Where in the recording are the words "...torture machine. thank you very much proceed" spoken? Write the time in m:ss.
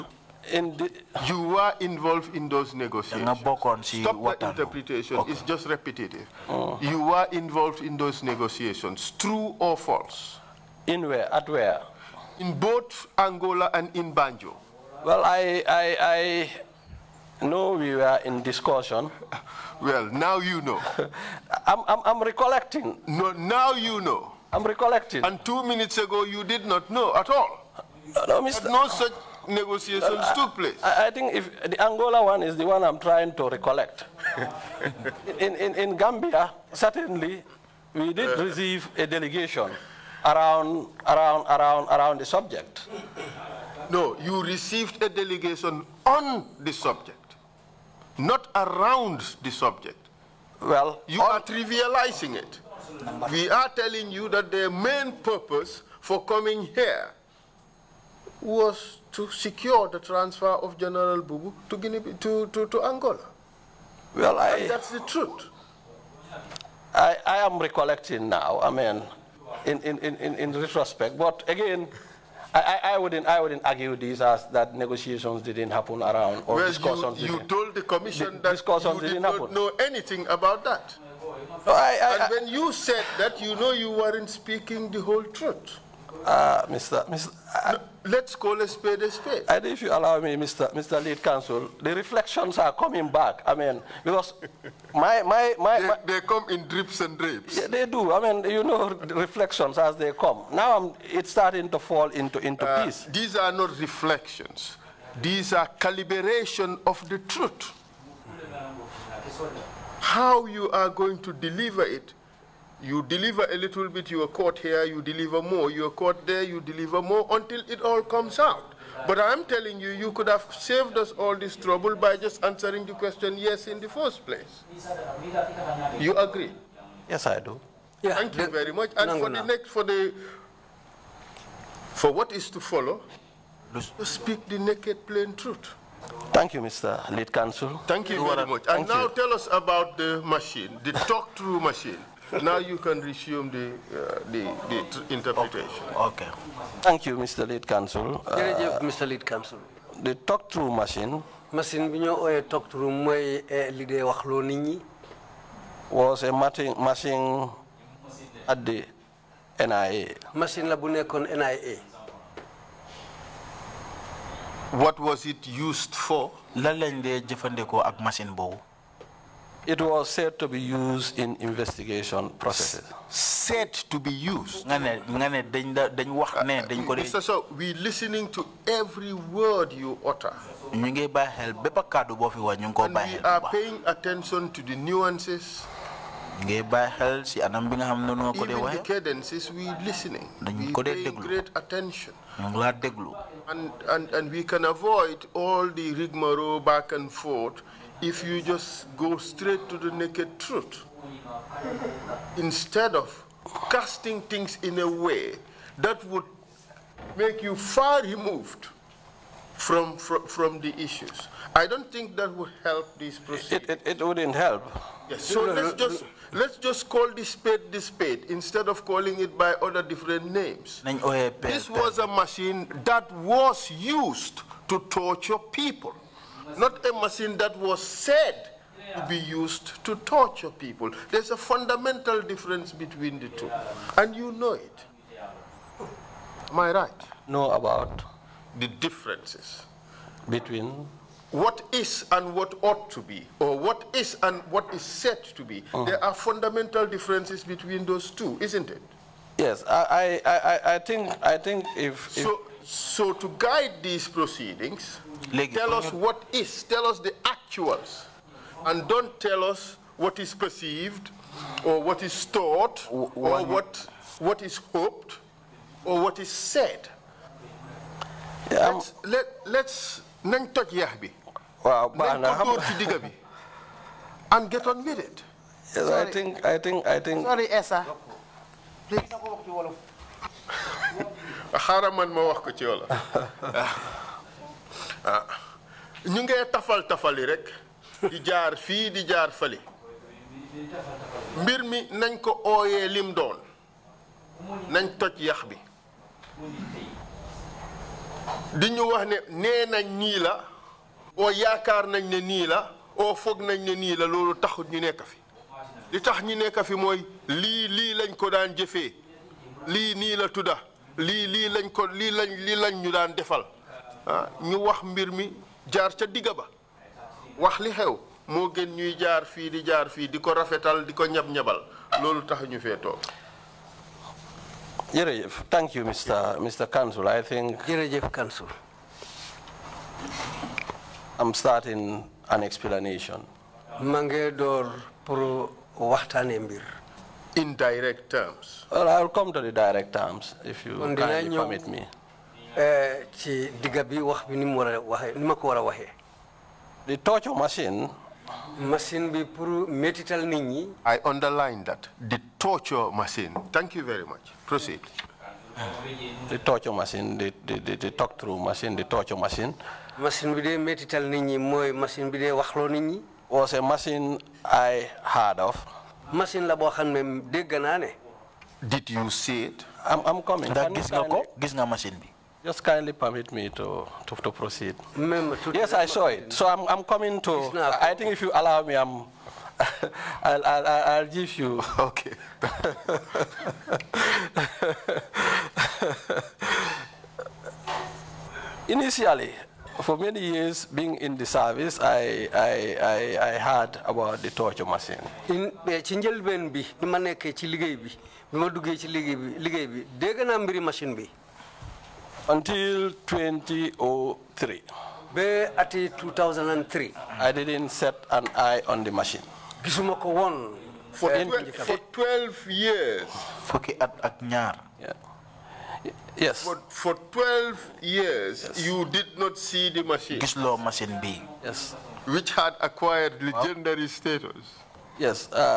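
5:52.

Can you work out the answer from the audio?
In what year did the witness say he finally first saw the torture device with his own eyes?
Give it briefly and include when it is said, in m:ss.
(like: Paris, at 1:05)
2003, at 6:42.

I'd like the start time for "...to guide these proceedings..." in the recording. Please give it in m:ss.
4:13.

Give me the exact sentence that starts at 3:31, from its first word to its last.
I don't think that would help this process.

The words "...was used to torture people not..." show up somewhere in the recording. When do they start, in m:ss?
3:43.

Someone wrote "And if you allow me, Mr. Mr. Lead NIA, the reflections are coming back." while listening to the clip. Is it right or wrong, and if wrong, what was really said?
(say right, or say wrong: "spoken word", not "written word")
wrong: "Counsel", not "NIA".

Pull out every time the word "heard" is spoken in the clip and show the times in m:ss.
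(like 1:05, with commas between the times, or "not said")
6:05, 6:33.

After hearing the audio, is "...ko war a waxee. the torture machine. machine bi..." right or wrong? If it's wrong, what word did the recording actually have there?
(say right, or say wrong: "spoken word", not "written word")
right.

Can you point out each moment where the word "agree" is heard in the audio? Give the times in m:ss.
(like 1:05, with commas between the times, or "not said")
2:06.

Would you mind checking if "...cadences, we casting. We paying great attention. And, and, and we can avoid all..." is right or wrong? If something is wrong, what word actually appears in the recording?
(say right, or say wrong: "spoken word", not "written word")
wrong: "listening", not "casting".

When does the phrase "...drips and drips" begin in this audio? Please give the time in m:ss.
1:36.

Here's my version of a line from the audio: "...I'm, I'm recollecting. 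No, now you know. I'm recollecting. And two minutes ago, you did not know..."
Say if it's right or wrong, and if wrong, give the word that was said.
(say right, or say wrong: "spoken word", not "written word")
right.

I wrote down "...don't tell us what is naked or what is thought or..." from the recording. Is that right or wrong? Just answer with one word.
wrong.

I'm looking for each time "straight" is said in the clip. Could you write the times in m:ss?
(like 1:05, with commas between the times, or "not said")
3:19.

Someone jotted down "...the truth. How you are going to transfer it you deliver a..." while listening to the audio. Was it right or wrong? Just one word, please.
wrong.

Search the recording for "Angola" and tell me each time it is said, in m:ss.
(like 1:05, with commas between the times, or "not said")
0:13, 0:31, 1:02.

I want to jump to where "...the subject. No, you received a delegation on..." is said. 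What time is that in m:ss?
0:42.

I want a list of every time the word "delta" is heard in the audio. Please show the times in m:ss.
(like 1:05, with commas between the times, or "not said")
not said.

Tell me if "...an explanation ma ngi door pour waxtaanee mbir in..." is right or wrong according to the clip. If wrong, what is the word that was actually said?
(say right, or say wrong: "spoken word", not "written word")
right.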